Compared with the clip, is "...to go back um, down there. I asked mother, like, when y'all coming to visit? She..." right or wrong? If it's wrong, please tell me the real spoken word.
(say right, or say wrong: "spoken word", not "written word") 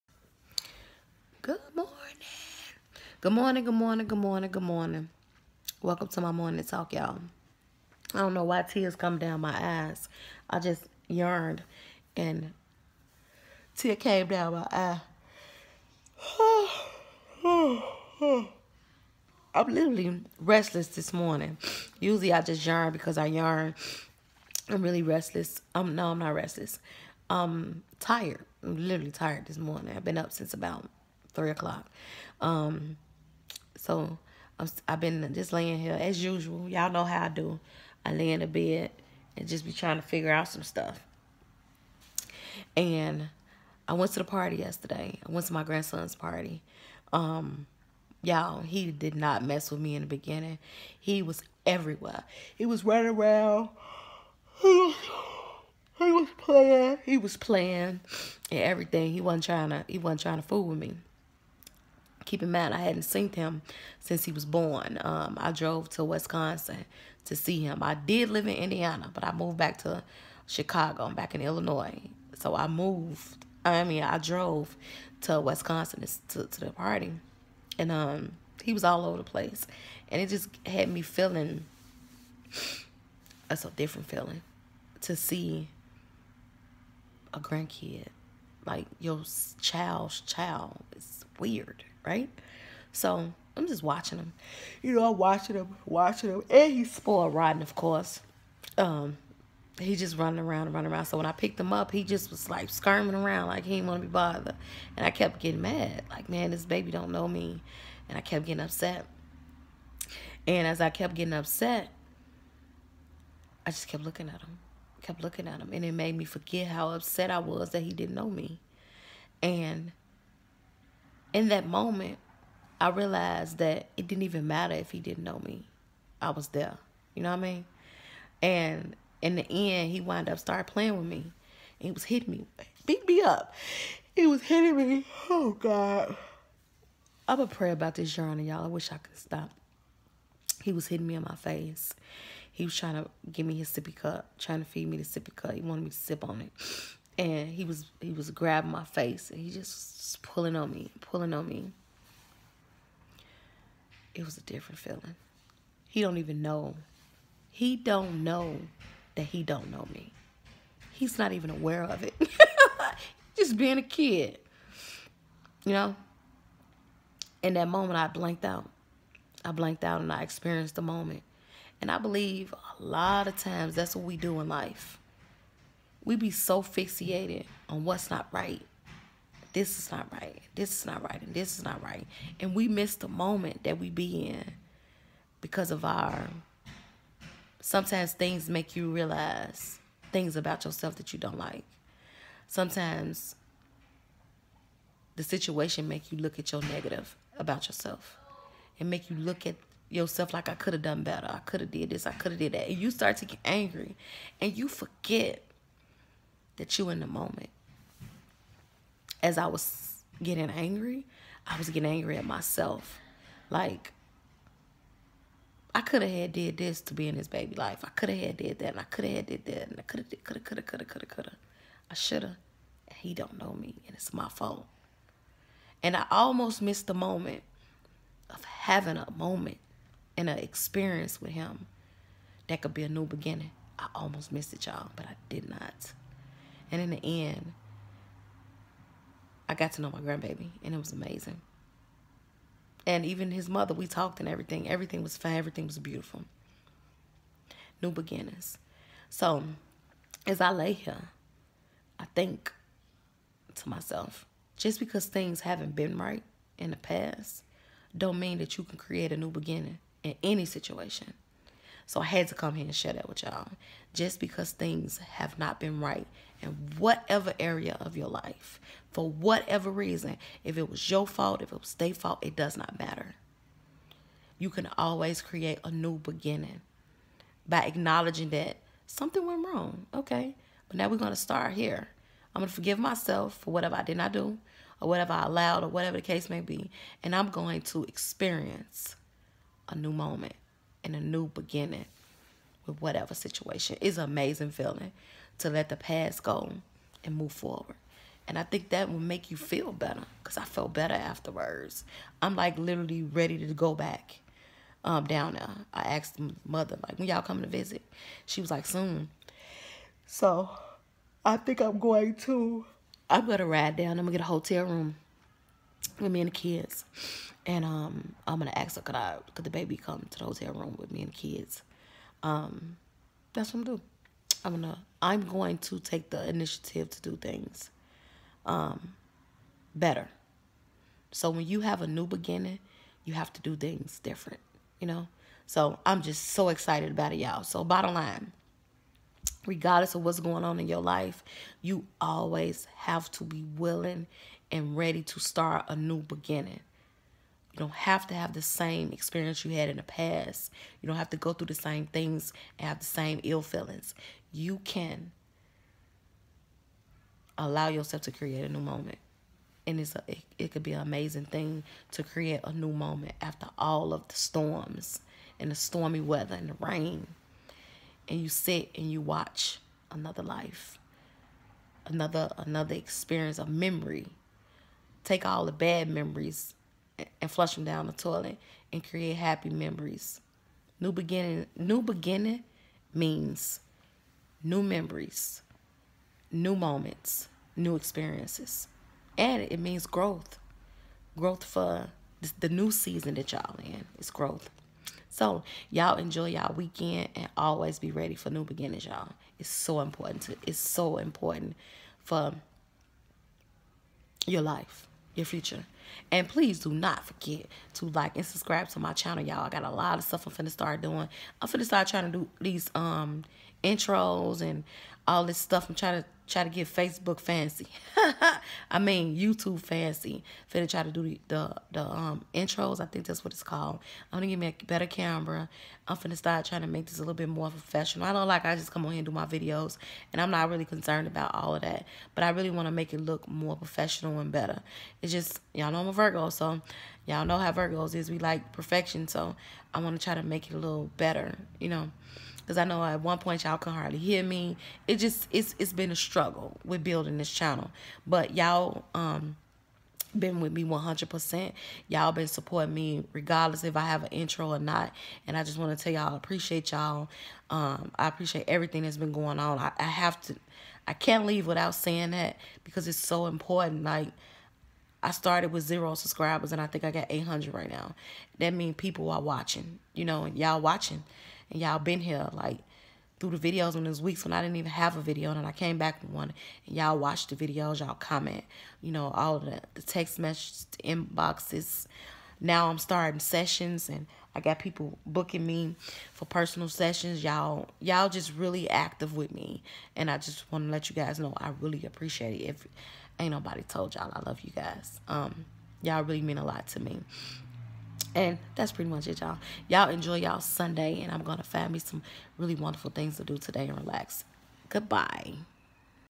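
right.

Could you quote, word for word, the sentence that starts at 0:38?
I lay in the bed and just be trying to figure out some stuff.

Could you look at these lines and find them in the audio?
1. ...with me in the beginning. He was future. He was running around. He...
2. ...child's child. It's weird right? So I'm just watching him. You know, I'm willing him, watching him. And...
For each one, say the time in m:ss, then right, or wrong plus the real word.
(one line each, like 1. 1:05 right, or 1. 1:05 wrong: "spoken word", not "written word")
1. 0:49 wrong: "everywhere", not "future"
2. 1:29 wrong: "watching", not "willing".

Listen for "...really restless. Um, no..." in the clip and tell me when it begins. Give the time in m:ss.
0:24.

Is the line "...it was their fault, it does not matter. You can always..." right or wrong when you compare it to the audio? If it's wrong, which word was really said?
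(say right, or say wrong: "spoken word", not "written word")
right.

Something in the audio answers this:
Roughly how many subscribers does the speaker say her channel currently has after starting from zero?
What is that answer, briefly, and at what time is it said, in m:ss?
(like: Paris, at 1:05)
800, at 7:47.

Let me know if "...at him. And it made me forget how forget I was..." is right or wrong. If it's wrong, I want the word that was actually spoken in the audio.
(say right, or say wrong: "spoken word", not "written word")
wrong: "upset", not "forget".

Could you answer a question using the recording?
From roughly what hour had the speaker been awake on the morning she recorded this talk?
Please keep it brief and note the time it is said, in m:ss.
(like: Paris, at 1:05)
3 o'clock, at 0:31.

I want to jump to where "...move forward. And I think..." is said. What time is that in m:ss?
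4:57.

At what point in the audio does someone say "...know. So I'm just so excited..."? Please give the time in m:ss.
5:34.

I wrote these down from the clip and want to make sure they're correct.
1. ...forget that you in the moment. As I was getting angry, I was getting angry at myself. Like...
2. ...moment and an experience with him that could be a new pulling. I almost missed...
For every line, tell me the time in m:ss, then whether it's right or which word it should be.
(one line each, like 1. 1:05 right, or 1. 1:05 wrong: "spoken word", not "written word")
1. 3:24 right
2. 3:49 wrong: "beginning", not "pulling".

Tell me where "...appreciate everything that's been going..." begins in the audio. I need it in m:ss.
7:38.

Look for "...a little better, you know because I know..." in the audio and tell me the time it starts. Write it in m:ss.
7:20.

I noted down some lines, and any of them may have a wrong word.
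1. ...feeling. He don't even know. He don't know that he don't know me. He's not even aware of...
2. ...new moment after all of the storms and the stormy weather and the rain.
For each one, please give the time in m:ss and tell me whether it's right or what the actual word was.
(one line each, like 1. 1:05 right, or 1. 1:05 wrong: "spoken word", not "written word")
1. 2:34 right
2. 6:02 right.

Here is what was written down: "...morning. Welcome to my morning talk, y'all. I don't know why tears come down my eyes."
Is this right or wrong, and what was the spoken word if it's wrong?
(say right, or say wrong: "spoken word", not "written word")
right.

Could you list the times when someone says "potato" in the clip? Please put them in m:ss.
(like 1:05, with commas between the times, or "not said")
not said.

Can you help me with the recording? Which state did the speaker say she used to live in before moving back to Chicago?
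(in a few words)
Indiana.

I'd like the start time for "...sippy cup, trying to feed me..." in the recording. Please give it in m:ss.
2:23.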